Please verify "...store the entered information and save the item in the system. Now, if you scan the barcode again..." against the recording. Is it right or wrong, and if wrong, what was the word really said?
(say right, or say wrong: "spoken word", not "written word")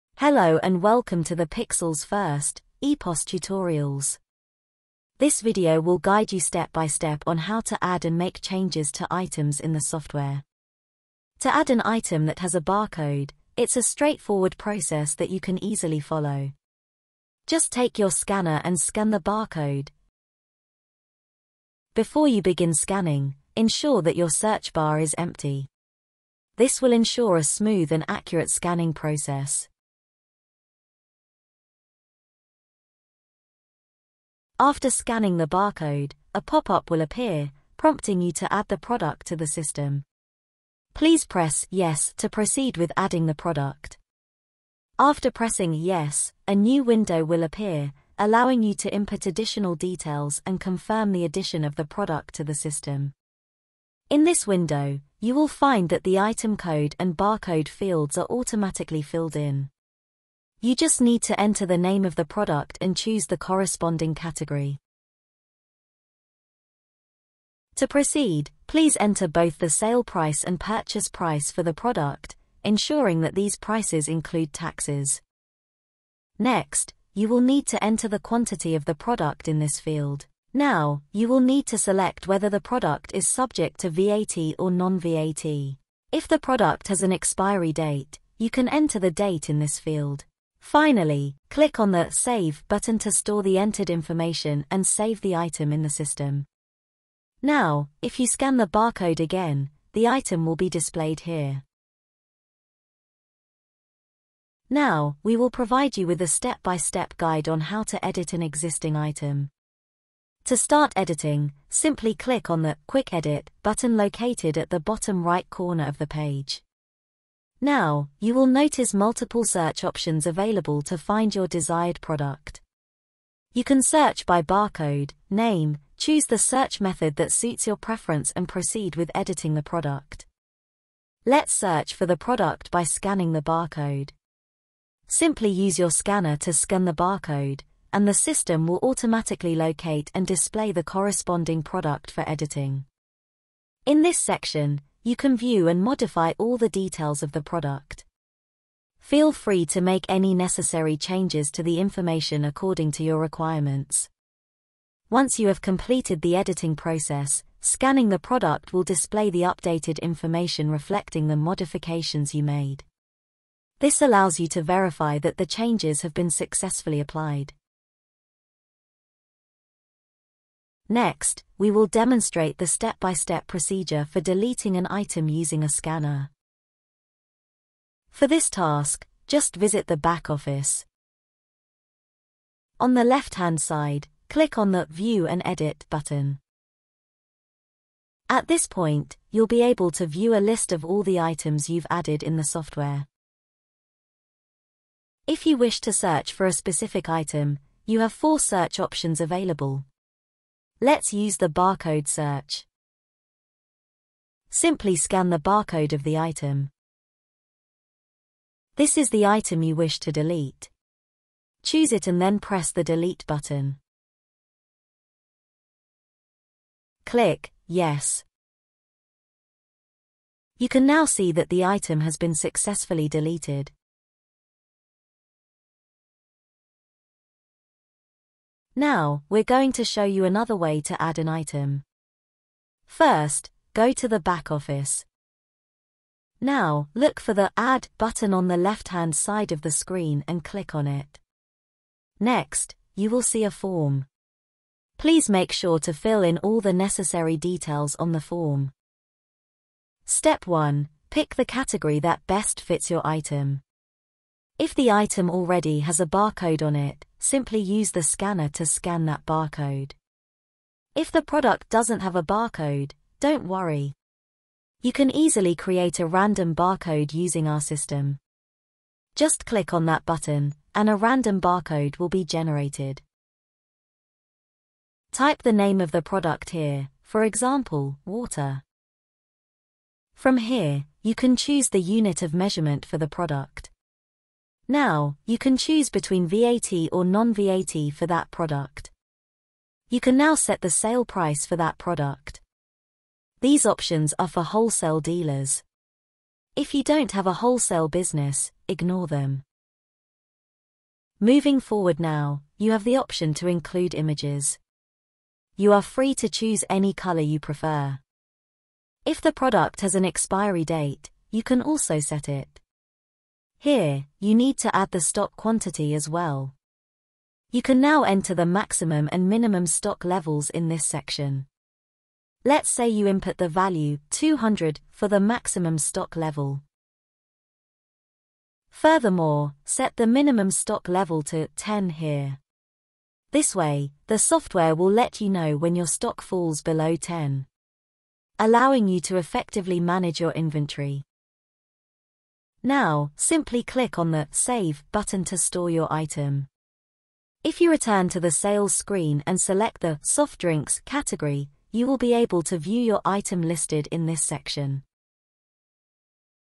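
right.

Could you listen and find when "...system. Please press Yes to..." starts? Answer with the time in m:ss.
0:39.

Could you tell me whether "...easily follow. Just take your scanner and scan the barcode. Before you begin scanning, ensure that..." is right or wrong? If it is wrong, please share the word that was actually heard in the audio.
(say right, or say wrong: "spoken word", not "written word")
right.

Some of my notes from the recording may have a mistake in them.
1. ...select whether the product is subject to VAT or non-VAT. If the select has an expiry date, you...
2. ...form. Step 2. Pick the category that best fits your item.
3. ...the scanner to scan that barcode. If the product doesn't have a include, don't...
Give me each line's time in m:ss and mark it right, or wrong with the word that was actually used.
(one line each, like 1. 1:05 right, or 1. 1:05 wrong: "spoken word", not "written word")
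1. 1:21 wrong: "product", not "select"
2. 4:08 wrong: "1", not "2"
3. 4:17 wrong: "barcode", not "include".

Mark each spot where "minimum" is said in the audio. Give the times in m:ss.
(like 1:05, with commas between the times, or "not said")
5:19, 5:30.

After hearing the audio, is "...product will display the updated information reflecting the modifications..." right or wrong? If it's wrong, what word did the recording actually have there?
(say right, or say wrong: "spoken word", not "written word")
right.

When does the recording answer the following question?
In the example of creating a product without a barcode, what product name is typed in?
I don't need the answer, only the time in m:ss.
4:38.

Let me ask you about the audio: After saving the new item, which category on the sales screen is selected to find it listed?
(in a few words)
soft drinks.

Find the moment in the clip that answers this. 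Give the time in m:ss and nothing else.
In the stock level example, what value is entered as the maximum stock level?
5:24.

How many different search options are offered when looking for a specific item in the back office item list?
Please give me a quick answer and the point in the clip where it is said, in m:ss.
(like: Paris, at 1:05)
4, at 3:18.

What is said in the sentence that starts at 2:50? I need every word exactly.
Next, we will demonstrate the step-by-step -step procedure for deleting an item using a scanner.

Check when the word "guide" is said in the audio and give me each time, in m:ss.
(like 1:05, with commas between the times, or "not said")
0:05, 1:47.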